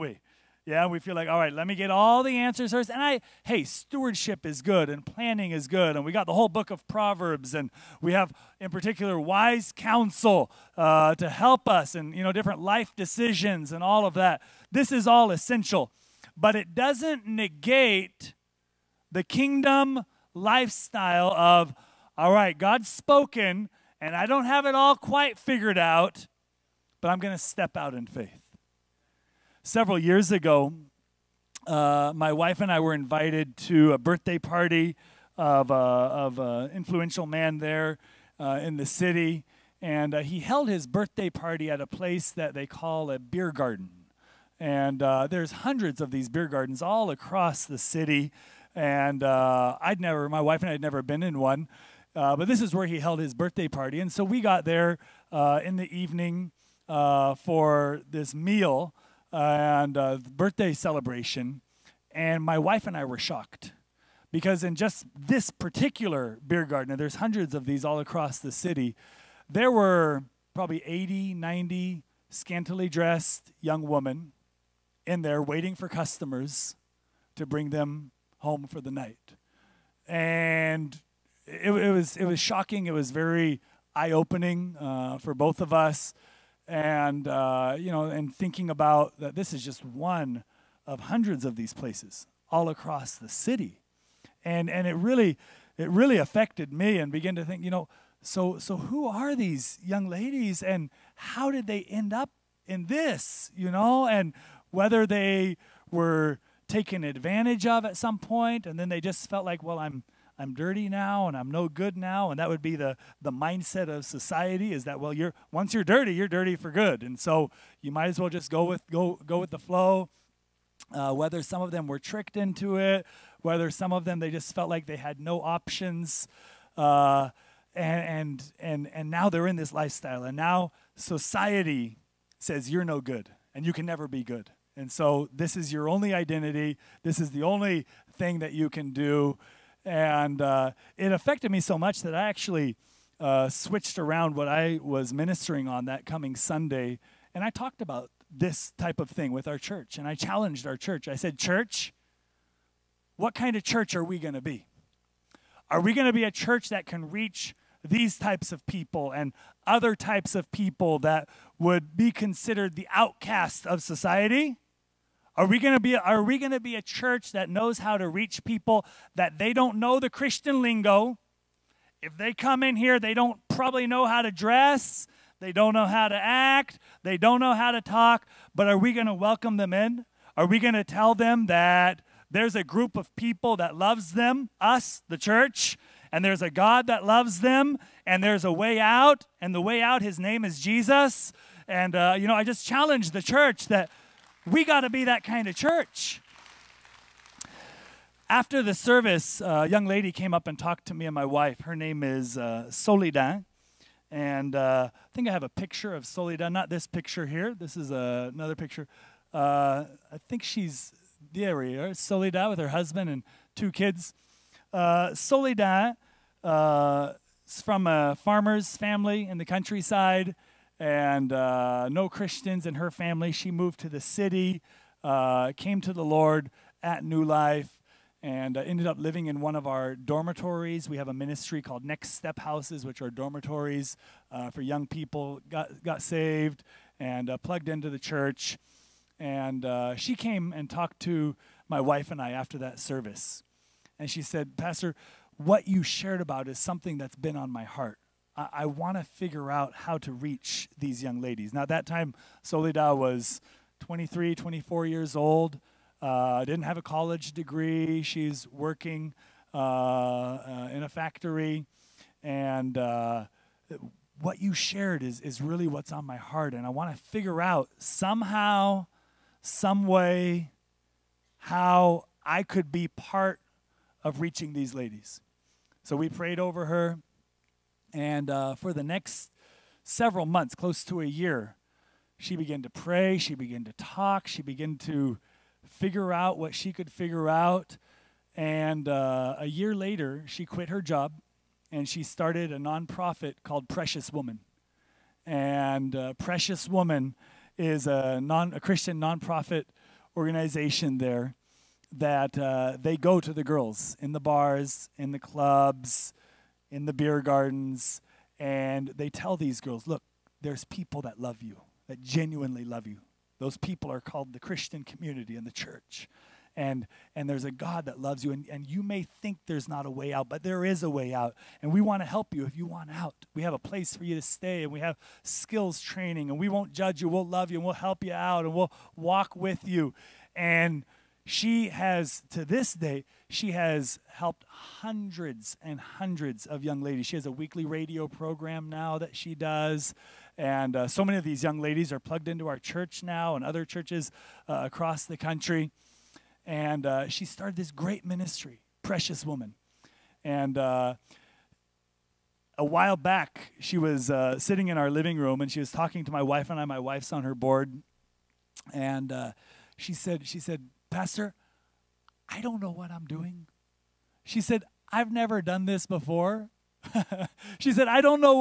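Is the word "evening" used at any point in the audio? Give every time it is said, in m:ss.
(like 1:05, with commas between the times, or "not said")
0:55.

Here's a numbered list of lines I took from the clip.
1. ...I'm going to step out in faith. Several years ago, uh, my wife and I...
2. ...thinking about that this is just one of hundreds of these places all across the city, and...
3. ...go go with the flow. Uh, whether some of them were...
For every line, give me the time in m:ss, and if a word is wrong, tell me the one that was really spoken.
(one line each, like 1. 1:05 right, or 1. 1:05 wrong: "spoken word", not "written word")
1. 0:27 right
2. 1:28 right
3. 1:58 right.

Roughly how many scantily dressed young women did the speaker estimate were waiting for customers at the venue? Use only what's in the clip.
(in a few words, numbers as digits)
80, 90.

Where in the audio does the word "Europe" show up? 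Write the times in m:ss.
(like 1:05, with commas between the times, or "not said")
not said.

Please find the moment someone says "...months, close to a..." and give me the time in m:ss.
4:40.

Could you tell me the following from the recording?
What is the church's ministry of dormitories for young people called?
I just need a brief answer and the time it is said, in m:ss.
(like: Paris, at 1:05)
Next Step Houses, at 3:51.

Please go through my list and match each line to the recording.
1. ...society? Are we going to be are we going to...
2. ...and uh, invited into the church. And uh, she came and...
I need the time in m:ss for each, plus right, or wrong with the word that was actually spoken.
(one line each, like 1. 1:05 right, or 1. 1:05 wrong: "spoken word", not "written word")
1. 2:43 right
2. 3:56 wrong: "plugged", not "invited".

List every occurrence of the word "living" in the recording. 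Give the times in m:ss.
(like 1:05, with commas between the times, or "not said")
3:48, 5:54.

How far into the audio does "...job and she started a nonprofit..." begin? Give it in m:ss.
4:50.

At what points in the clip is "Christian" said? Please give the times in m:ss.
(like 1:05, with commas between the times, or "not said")
2:50, 3:42, 4:58, 5:14.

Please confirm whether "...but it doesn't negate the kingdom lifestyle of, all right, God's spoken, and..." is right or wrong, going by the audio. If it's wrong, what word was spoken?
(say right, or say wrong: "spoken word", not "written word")
right.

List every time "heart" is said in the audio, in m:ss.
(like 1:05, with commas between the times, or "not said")
4:07, 4:26.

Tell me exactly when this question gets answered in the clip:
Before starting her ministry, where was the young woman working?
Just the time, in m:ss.
4:20.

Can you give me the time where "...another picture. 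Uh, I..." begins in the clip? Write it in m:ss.
3:28.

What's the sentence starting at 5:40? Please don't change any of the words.
And uh, so many of these young ladies are plugged into our church now and other churches uh, across the country.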